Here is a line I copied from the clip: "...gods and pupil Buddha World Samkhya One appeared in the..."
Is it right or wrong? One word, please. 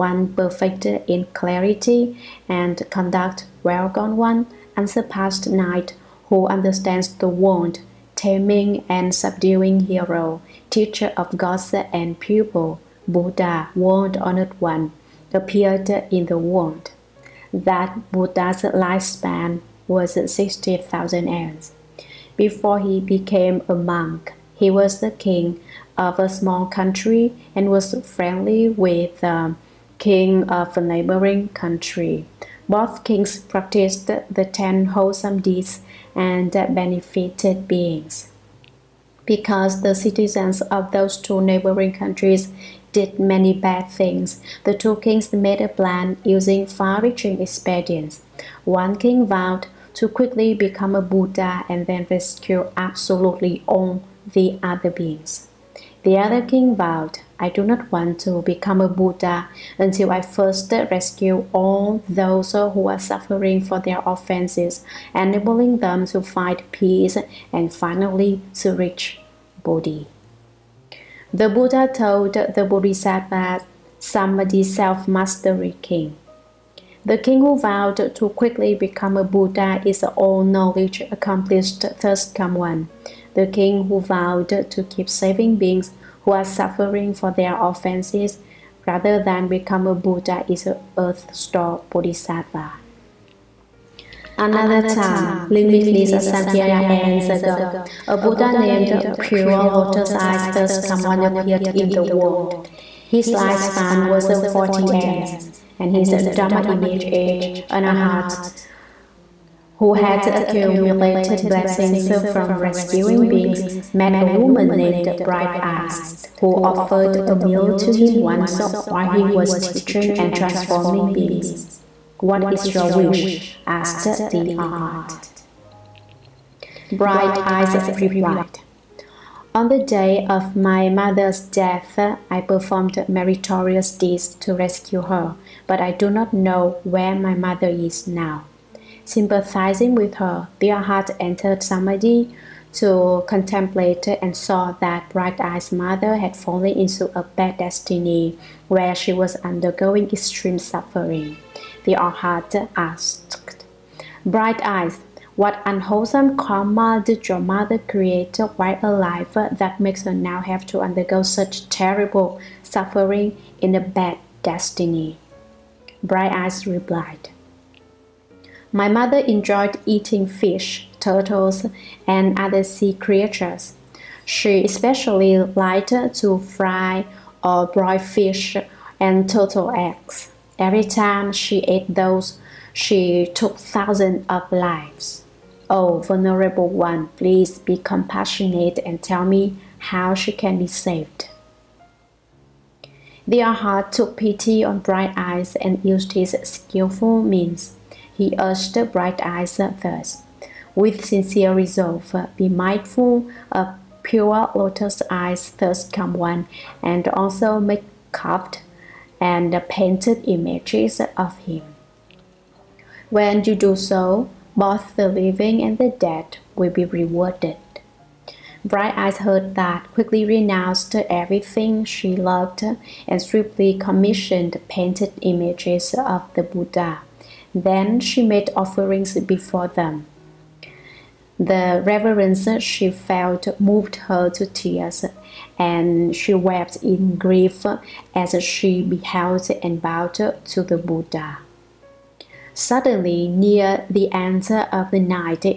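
wrong.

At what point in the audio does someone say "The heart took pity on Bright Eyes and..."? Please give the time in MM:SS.
03:13.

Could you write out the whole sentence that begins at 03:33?
When you do so, both the living and the dead will be rewarded.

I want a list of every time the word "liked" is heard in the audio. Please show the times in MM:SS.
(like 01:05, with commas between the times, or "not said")
02:55.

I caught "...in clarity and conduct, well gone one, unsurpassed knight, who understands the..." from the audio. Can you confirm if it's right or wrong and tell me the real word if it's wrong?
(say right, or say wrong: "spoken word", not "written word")
right.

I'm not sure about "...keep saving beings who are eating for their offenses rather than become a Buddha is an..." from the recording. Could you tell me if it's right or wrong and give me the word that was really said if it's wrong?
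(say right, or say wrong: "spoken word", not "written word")
wrong: "suffering", not "eating".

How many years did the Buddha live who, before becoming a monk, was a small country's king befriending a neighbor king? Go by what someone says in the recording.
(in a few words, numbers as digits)
60,000 years.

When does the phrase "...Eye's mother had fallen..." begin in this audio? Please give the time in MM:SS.
02:25.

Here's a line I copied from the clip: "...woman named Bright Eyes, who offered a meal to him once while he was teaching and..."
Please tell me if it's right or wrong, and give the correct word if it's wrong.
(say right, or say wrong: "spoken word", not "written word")
right.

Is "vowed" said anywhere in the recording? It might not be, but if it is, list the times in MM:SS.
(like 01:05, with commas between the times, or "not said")
00:49, 00:56, 01:17, 01:24.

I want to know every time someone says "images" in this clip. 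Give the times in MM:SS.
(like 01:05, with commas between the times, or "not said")
01:46, 03:30, 03:45.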